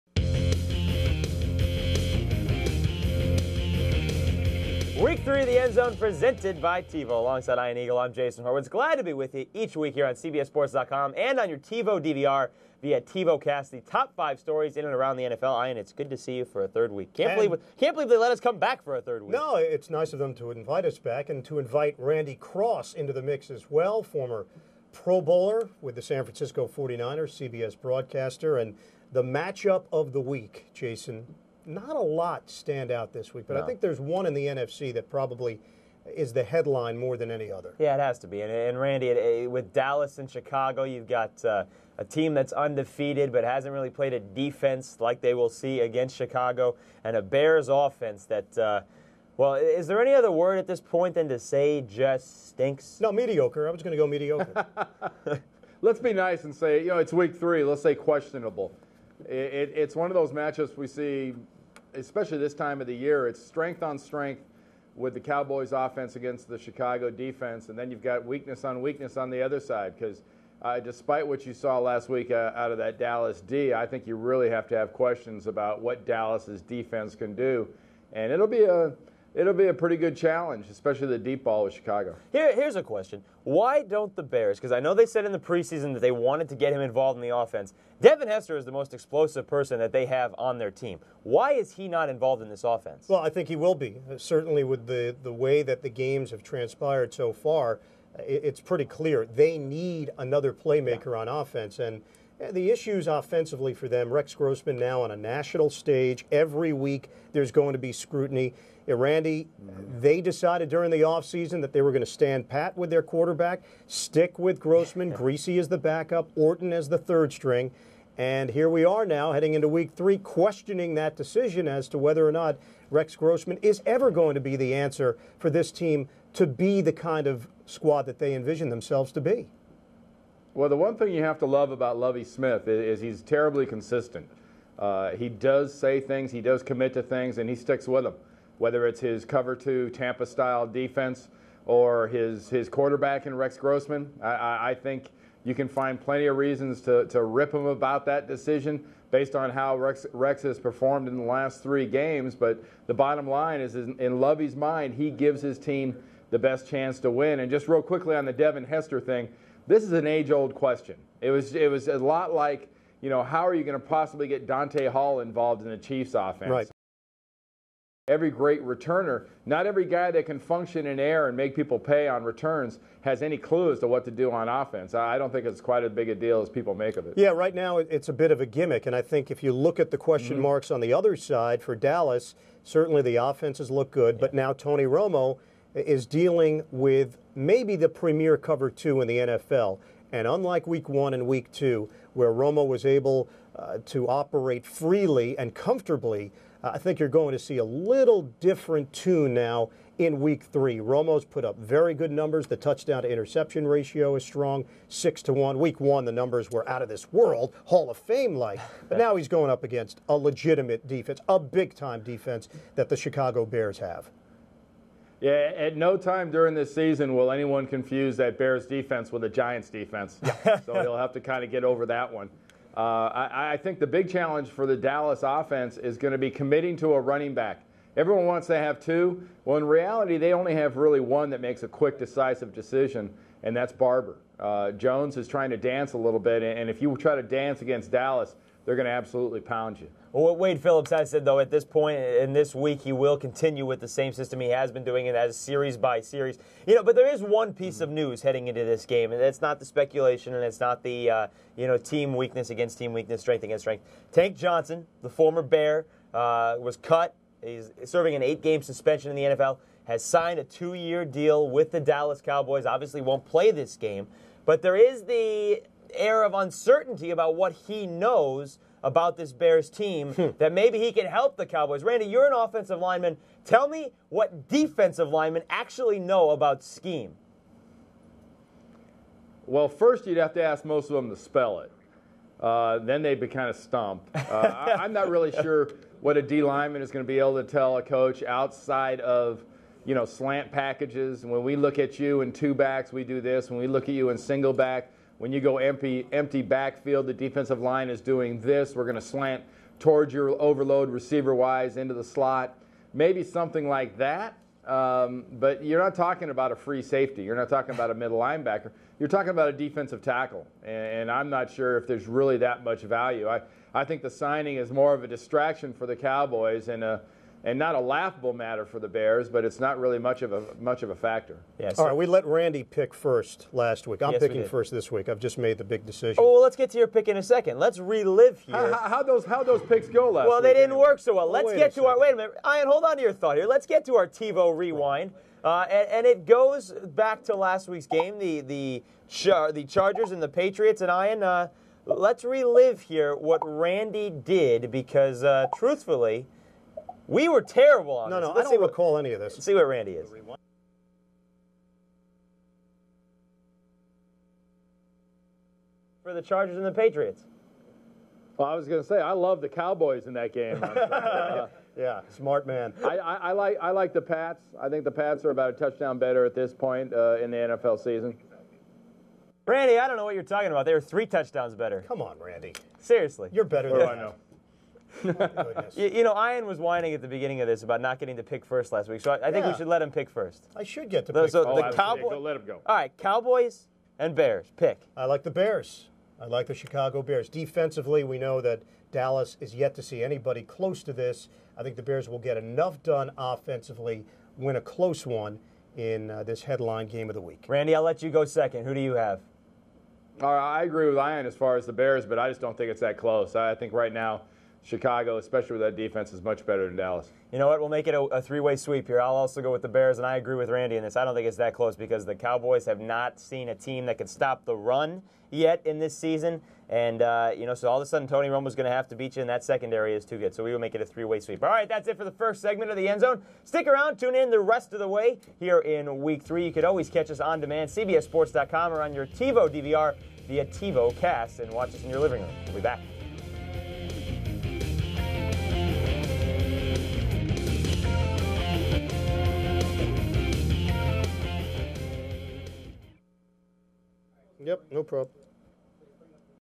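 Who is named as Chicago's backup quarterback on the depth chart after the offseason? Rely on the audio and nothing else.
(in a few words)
Griese.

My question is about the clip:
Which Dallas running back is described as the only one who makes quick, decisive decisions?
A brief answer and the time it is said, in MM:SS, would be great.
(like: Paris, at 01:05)
Barber, at 03:53.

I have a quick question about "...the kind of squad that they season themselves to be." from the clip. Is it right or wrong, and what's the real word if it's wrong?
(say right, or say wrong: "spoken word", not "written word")
wrong: "envision", not "season".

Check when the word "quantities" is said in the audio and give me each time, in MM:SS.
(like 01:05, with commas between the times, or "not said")
not said.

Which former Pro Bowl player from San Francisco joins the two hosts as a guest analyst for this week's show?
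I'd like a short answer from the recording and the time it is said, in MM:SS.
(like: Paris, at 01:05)
Randy Cross, at 00:21.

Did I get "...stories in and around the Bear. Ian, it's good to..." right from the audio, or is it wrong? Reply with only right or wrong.
wrong.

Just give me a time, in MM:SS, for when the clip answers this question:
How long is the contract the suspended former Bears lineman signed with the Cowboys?
04:20.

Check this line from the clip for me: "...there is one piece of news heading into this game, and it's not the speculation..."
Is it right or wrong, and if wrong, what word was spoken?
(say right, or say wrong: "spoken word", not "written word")
right.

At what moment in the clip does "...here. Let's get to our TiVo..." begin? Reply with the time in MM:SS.
05:33.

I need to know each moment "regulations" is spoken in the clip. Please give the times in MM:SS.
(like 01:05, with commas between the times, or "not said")
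not said.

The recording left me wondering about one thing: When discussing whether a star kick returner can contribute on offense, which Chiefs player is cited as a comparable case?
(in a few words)
Dante Hall.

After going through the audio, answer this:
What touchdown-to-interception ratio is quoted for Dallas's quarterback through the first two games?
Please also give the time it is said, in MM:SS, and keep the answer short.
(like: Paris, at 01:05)
6 to 1, at 03:24.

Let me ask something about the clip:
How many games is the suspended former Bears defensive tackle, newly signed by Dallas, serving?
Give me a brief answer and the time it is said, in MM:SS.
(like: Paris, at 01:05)
8, at 04:18.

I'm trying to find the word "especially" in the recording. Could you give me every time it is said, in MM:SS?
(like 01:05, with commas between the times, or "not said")
01:01, 01:20, 06:45.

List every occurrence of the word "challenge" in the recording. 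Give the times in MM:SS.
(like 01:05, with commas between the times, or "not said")
01:20, 03:44.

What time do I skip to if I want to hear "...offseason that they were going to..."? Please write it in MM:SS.
01:51.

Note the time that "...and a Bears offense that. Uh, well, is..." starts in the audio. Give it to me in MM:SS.
00:47.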